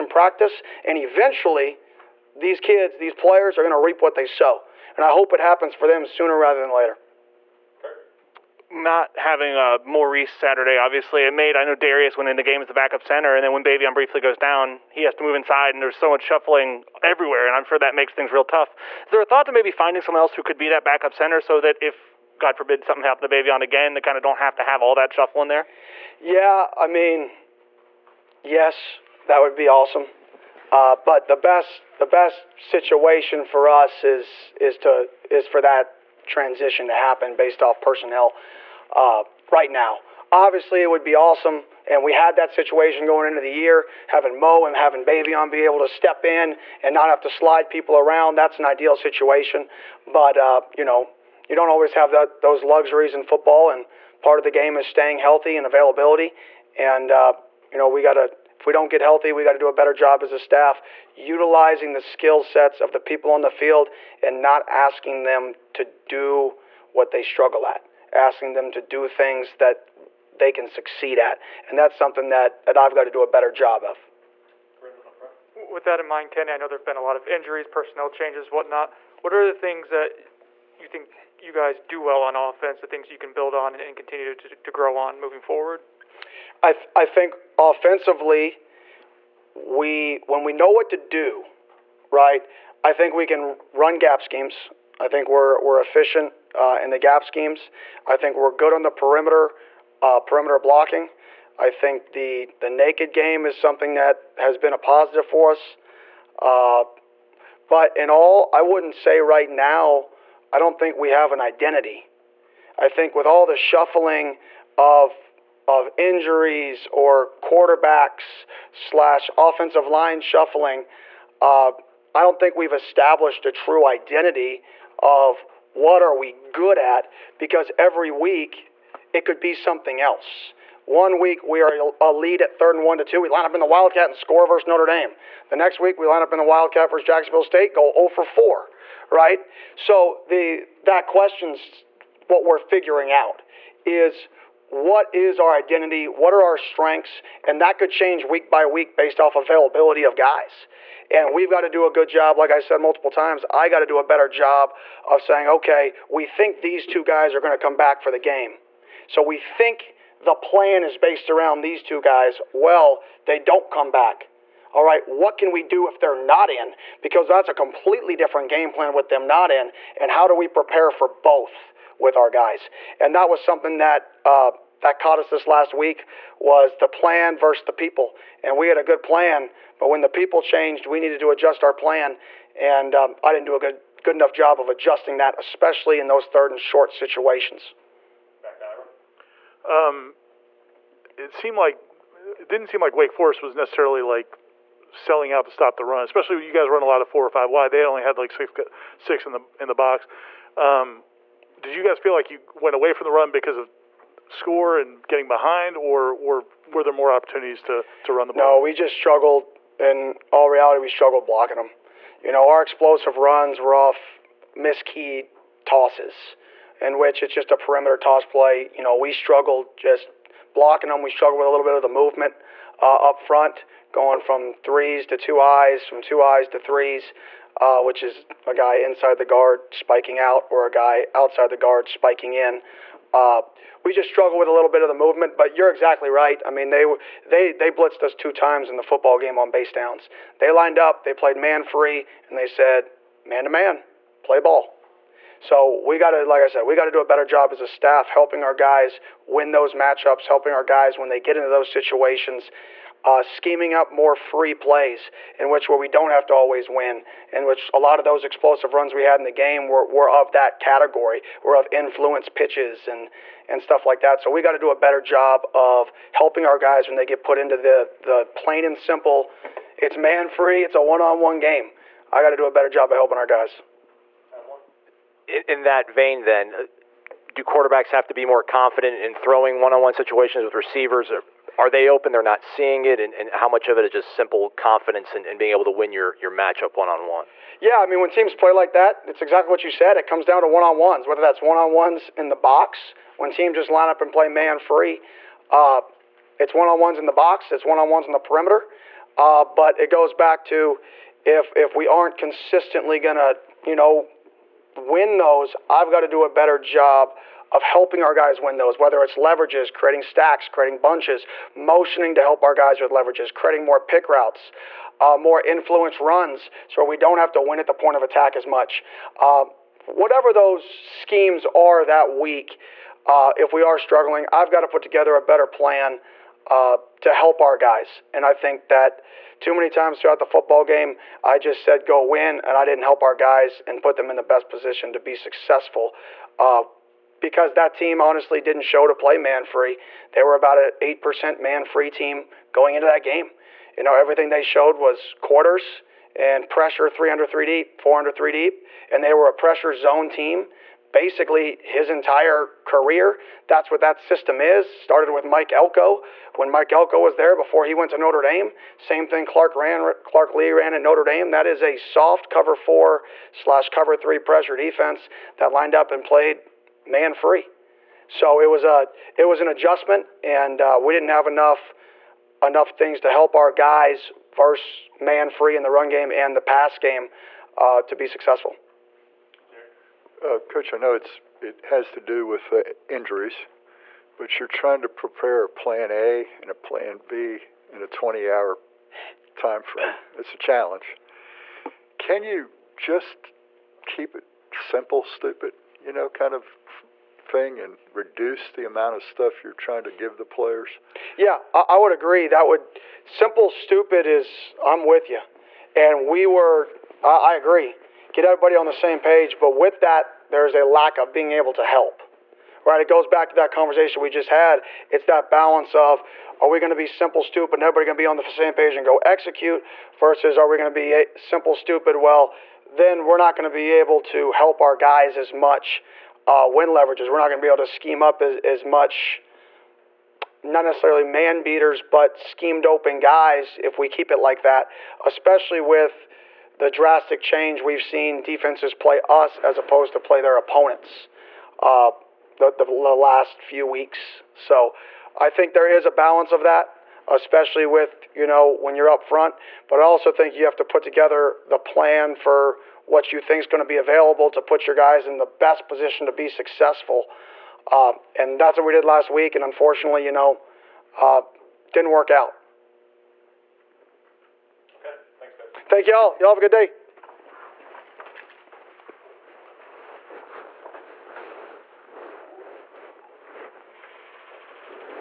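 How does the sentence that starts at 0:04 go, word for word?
And I hope it happens for them sooner rather than later.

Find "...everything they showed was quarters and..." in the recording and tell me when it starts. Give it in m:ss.
5:43.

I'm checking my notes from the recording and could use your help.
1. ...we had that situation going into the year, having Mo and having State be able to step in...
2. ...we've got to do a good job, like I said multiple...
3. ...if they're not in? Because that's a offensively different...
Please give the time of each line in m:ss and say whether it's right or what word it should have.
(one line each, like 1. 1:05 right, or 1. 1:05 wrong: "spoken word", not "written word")
1. 0:42 wrong: "Baveon", not "State"
2. 2:31 right
3. 2:45 wrong: "completely", not "offensively".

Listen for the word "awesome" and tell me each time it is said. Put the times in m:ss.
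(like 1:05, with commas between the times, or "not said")
0:29, 0:41.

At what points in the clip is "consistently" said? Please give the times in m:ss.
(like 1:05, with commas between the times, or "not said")
5:02.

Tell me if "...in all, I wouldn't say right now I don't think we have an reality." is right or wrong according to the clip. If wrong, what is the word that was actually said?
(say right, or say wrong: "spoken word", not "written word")
wrong: "identity", not "reality".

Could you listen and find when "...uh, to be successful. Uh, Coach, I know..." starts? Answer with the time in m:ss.
6:17.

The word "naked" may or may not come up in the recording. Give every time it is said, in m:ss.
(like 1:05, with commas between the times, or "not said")
1:42.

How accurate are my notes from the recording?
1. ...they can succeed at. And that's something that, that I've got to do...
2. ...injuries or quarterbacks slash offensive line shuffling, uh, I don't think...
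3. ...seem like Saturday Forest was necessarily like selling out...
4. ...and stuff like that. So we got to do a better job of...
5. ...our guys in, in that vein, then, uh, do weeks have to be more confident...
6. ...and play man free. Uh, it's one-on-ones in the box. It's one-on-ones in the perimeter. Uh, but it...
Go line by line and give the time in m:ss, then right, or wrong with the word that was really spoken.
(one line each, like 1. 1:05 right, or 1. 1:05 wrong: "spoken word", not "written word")
1. 1:10 right
2. 1:55 right
3. 3:12 wrong: "Wake", not "Saturday"
4. 4:23 right
5. 4:33 wrong: "quarterbacks", not "weeks"
6. 4:53 right.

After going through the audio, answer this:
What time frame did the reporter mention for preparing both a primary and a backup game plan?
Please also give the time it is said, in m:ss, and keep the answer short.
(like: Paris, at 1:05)
20 hours, at 6:27.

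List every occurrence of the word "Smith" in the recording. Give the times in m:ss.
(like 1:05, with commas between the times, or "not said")
not said.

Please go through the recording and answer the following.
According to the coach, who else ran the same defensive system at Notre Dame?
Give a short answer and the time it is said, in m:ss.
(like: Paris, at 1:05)
Clark Lea, at 6:00.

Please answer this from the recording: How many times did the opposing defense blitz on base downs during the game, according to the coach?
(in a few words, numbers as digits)
2.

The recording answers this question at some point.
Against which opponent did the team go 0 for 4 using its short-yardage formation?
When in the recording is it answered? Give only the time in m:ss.
2:17.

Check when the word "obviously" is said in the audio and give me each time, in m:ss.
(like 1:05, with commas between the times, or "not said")
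0:10, 0:40.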